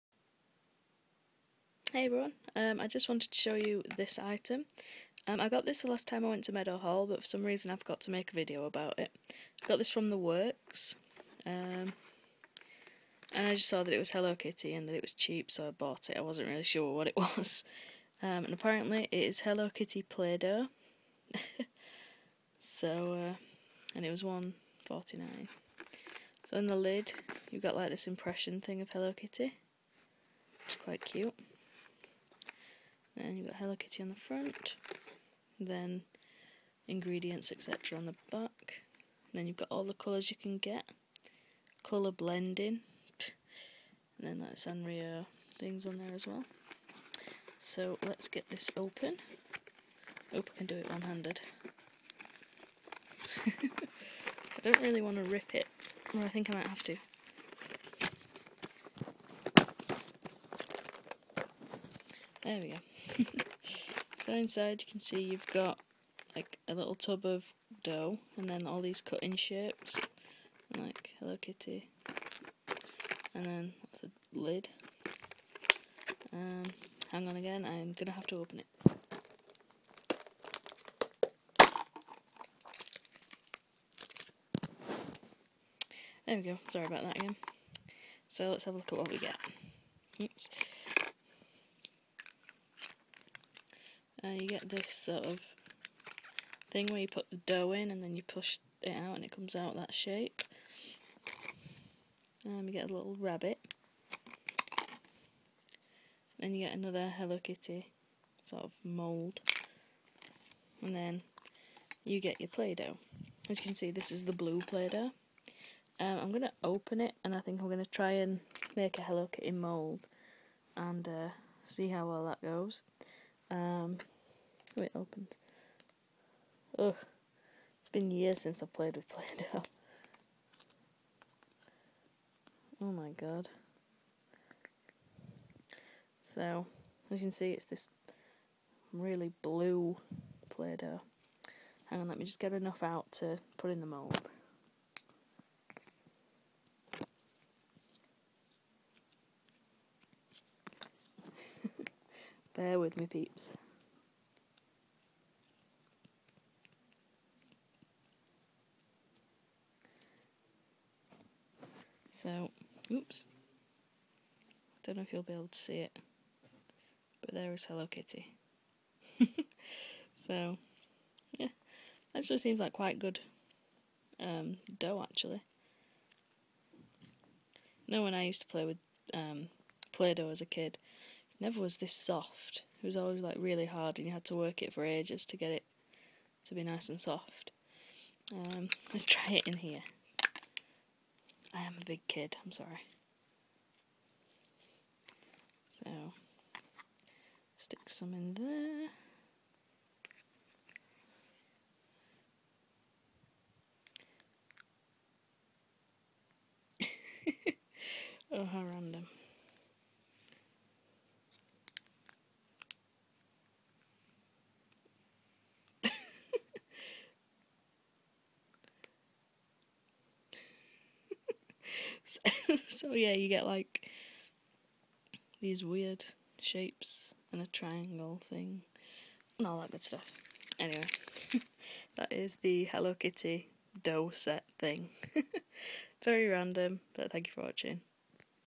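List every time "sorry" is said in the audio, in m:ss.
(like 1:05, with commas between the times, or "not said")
1:26, 3:12.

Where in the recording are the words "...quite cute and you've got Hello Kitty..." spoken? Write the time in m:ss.
0:30.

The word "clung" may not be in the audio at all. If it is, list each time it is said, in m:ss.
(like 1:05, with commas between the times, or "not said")
not said.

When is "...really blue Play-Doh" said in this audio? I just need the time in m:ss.
2:18.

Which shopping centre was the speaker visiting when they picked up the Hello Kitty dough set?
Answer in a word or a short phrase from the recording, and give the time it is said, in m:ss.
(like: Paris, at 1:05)
Meadowhall, at 0:06.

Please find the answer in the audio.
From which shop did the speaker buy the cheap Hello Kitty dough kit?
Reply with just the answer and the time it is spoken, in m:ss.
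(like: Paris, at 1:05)
The Works, at 0:10.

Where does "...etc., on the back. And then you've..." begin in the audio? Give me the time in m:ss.
0:37.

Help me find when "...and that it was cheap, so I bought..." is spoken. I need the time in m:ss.
0:14.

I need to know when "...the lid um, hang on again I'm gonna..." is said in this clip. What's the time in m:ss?
1:14.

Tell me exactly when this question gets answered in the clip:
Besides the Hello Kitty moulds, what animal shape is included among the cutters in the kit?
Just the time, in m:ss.
1:43.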